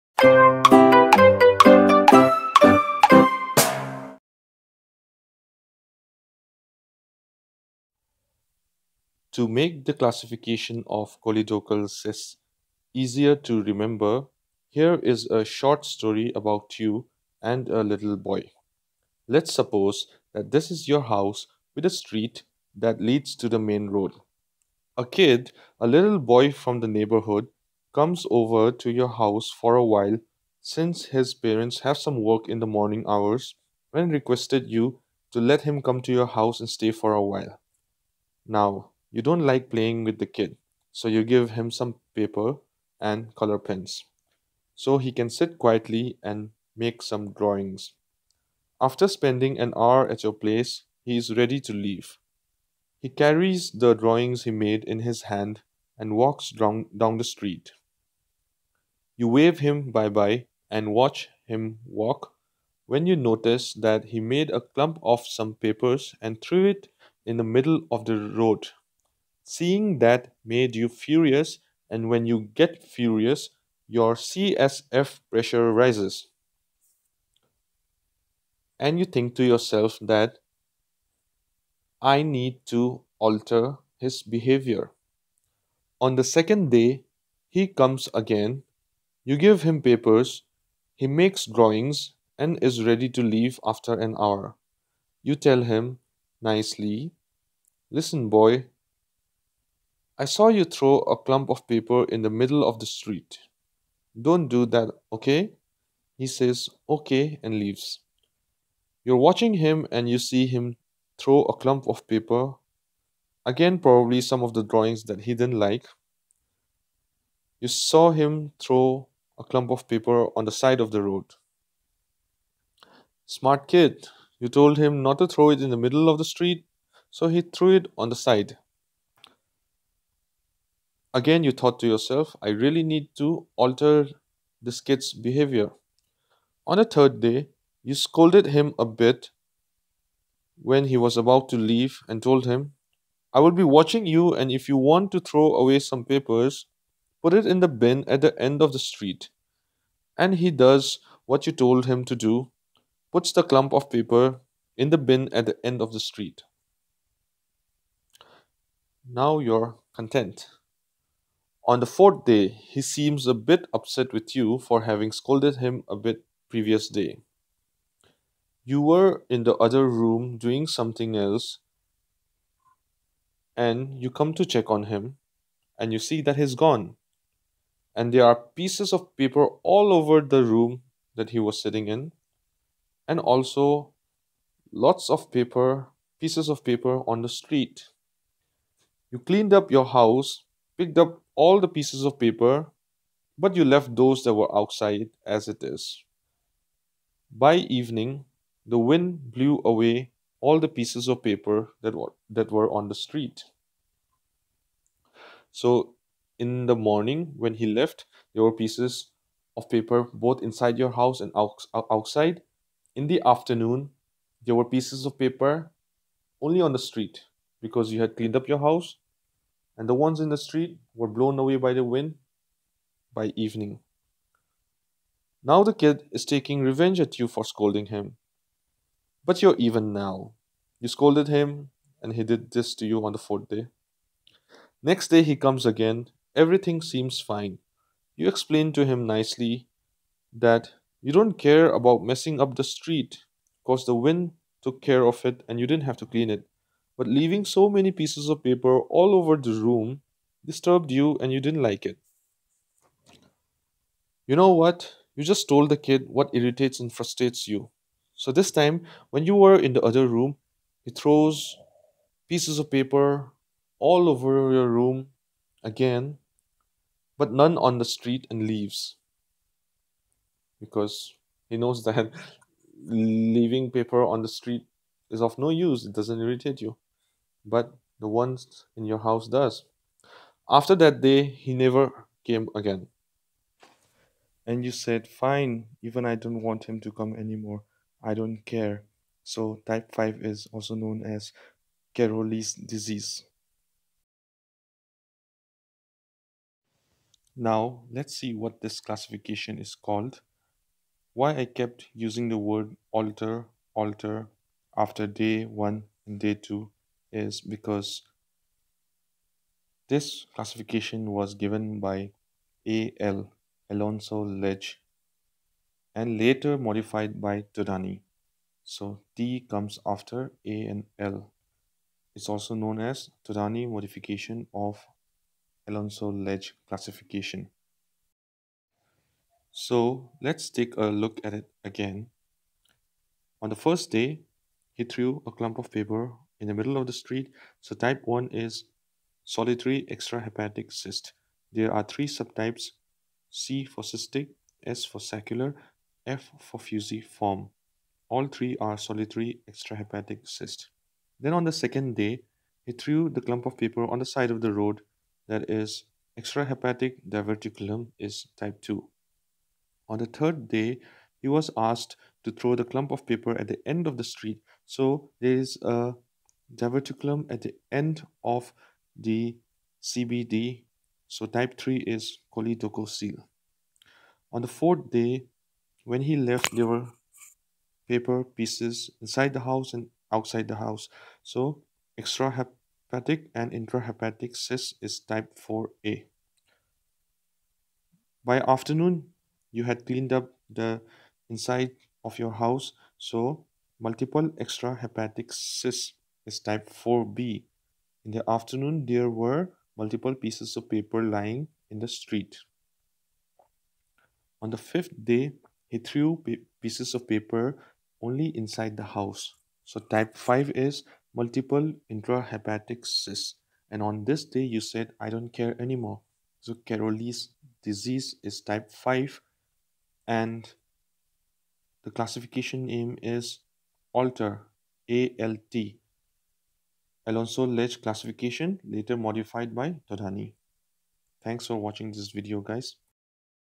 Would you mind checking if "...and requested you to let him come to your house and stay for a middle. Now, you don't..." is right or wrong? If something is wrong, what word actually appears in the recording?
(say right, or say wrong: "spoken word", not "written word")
wrong: "while", not "middle".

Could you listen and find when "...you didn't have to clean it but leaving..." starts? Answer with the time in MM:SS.
04:05.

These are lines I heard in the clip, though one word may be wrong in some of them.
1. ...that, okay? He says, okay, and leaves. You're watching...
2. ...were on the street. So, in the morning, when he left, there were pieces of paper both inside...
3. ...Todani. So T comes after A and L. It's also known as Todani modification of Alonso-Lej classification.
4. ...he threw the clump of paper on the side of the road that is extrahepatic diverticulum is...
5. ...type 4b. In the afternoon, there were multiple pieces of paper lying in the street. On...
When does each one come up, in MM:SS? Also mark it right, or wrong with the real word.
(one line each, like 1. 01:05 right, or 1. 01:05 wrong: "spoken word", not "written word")
1. 01:44 right
2. 03:22 right
3. 05:17 right
4. 05:52 right
5. 06:36 right.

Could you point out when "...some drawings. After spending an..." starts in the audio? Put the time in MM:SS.
00:47.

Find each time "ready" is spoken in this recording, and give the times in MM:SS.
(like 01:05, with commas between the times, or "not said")
00:51, 01:32.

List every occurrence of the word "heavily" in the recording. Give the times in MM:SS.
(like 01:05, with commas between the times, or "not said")
not said.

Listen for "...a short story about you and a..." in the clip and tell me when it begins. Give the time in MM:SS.
00:15.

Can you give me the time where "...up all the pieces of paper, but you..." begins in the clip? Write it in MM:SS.
03:10.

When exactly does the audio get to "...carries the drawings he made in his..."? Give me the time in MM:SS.
00:53.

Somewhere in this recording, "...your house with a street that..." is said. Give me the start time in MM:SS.
00:20.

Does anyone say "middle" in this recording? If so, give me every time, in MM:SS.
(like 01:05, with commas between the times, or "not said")
01:07, 01:42, 02:05, 05:36.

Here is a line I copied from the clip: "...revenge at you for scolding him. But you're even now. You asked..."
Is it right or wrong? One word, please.
wrong.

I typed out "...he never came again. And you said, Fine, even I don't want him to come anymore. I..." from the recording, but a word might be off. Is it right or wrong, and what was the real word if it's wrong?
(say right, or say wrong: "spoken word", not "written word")
right.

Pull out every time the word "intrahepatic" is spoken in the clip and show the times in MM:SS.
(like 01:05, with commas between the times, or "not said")
06:23, 06:51.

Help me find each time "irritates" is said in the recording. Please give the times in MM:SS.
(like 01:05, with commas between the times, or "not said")
04:16, 04:36.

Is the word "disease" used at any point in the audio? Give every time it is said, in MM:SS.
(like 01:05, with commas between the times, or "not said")
04:52, 06:57.